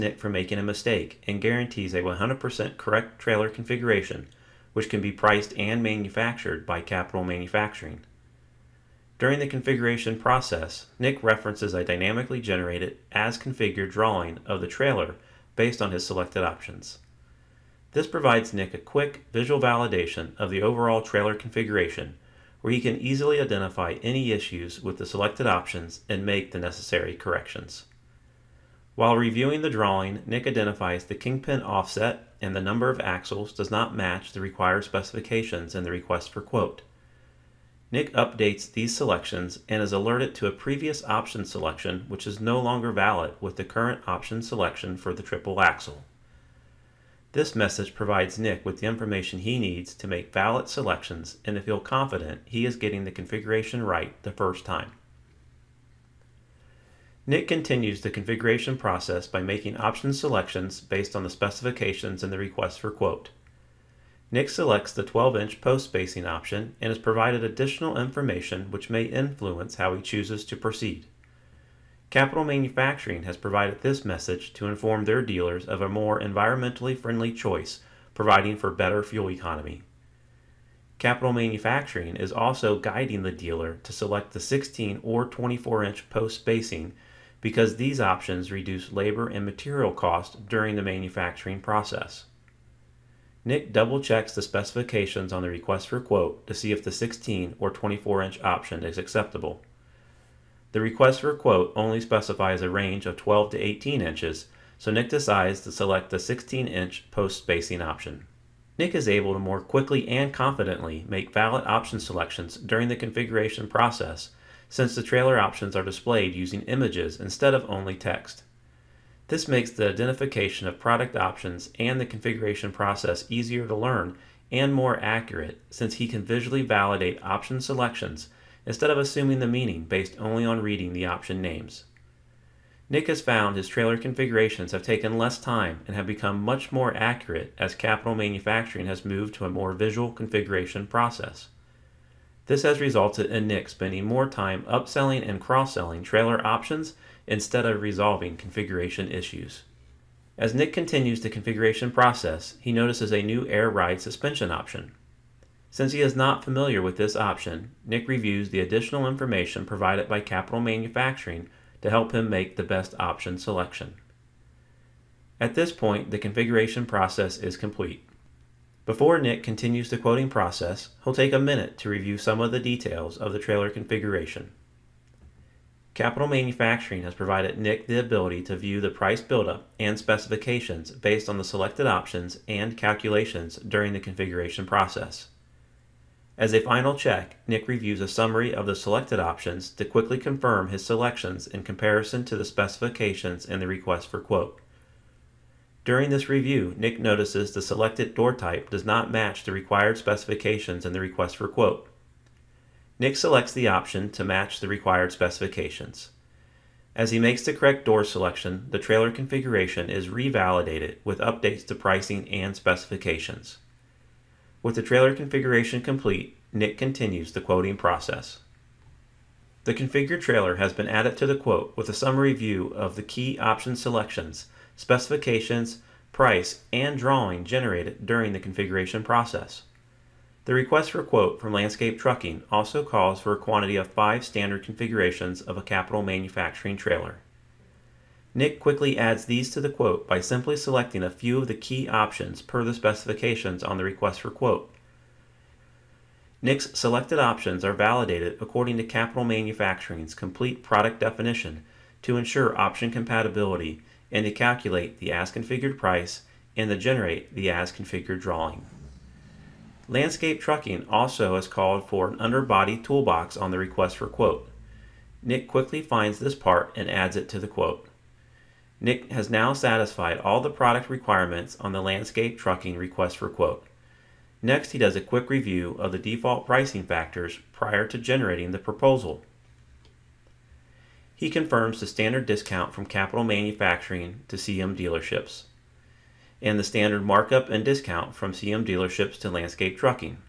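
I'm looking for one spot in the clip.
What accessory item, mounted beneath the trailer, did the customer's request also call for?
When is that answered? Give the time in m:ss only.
4:22.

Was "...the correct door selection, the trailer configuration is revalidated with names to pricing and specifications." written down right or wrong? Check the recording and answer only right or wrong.
wrong.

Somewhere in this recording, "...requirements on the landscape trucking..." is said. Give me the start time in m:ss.
4:30.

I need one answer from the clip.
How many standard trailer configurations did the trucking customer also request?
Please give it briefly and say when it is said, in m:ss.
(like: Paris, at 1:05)
5, at 3:53.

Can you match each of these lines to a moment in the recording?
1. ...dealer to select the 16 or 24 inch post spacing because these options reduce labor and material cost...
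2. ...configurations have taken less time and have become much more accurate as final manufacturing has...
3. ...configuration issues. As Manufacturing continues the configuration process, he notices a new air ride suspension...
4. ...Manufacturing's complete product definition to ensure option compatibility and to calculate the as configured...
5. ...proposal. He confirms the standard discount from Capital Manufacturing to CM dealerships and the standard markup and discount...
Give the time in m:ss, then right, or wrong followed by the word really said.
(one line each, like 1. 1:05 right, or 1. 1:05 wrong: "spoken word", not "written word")
1. 1:23 right
2. 2:13 wrong: "capital", not "final"
3. 2:28 wrong: "Nick", not "Manufacturing"
4. 4:09 right
5. 4:38 right.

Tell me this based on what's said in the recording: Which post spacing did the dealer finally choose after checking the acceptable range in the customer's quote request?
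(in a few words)
16 inch.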